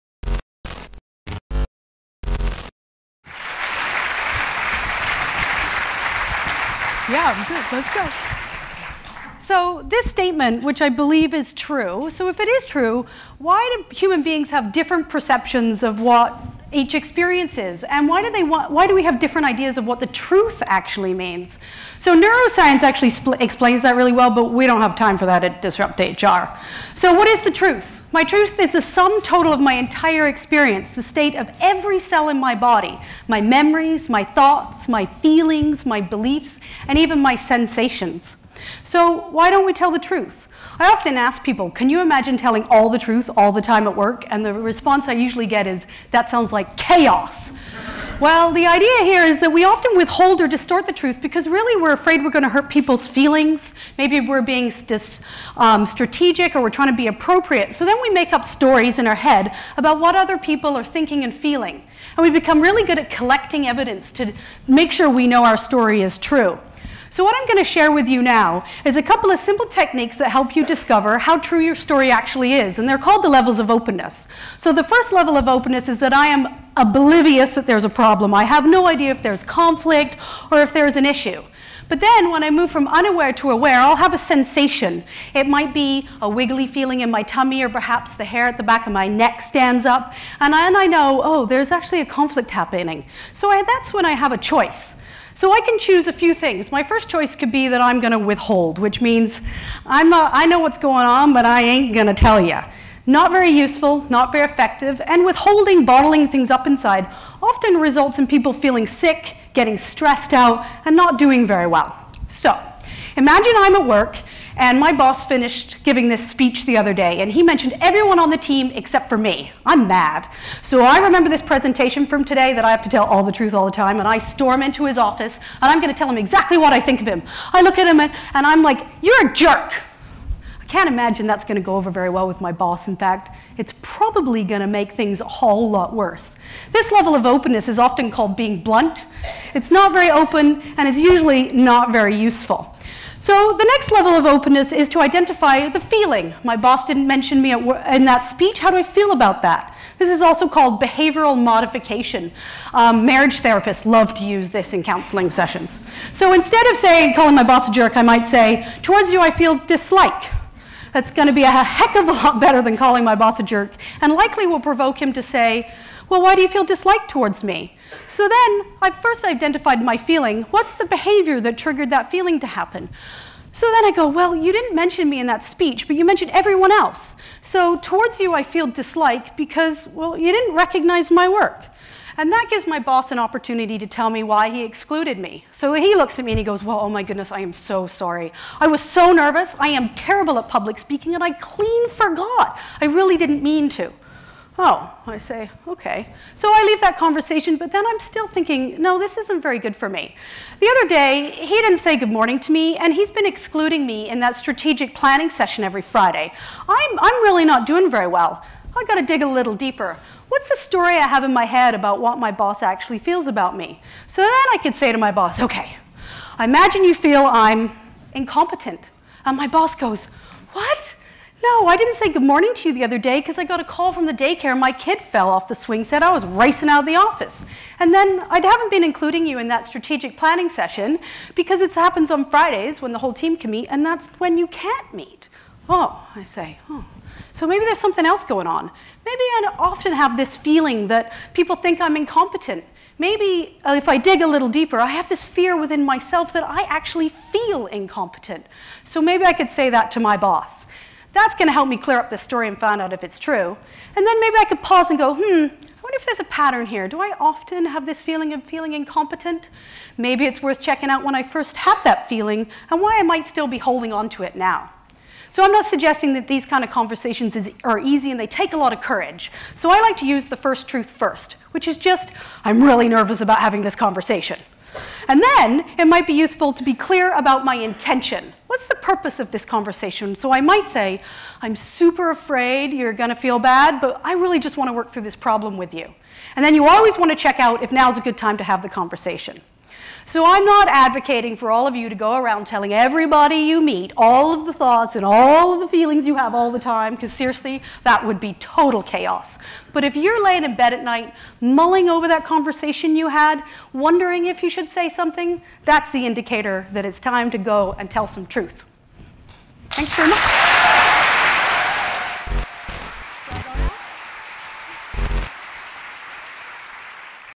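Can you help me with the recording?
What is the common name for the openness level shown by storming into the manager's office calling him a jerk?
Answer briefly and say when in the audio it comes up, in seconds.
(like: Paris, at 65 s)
being blunt, at 138 s.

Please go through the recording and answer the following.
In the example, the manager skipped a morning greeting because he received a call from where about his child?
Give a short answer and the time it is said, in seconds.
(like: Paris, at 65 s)
the daycare, at 224 s.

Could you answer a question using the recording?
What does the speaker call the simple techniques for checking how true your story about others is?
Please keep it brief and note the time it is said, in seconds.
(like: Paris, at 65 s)
levels of openness, at 73 s.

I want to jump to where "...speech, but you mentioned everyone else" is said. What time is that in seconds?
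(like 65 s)
175 s.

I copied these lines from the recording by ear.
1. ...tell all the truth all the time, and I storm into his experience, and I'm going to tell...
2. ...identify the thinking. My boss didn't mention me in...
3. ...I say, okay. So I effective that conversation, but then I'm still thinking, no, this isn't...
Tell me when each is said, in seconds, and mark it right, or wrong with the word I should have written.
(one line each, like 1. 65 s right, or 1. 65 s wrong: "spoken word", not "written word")
1. 122 s wrong: "office", not "experience"
2. 145 s wrong: "feeling", not "thinking"
3. 195 s wrong: "leave", not "effective".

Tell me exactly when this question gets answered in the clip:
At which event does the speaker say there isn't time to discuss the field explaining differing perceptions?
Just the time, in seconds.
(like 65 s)
25 s.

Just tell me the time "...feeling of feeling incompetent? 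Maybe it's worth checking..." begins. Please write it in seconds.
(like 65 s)
258 s.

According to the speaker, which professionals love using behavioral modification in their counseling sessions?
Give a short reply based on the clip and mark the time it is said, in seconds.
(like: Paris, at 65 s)
marriage therapists, at 153 s.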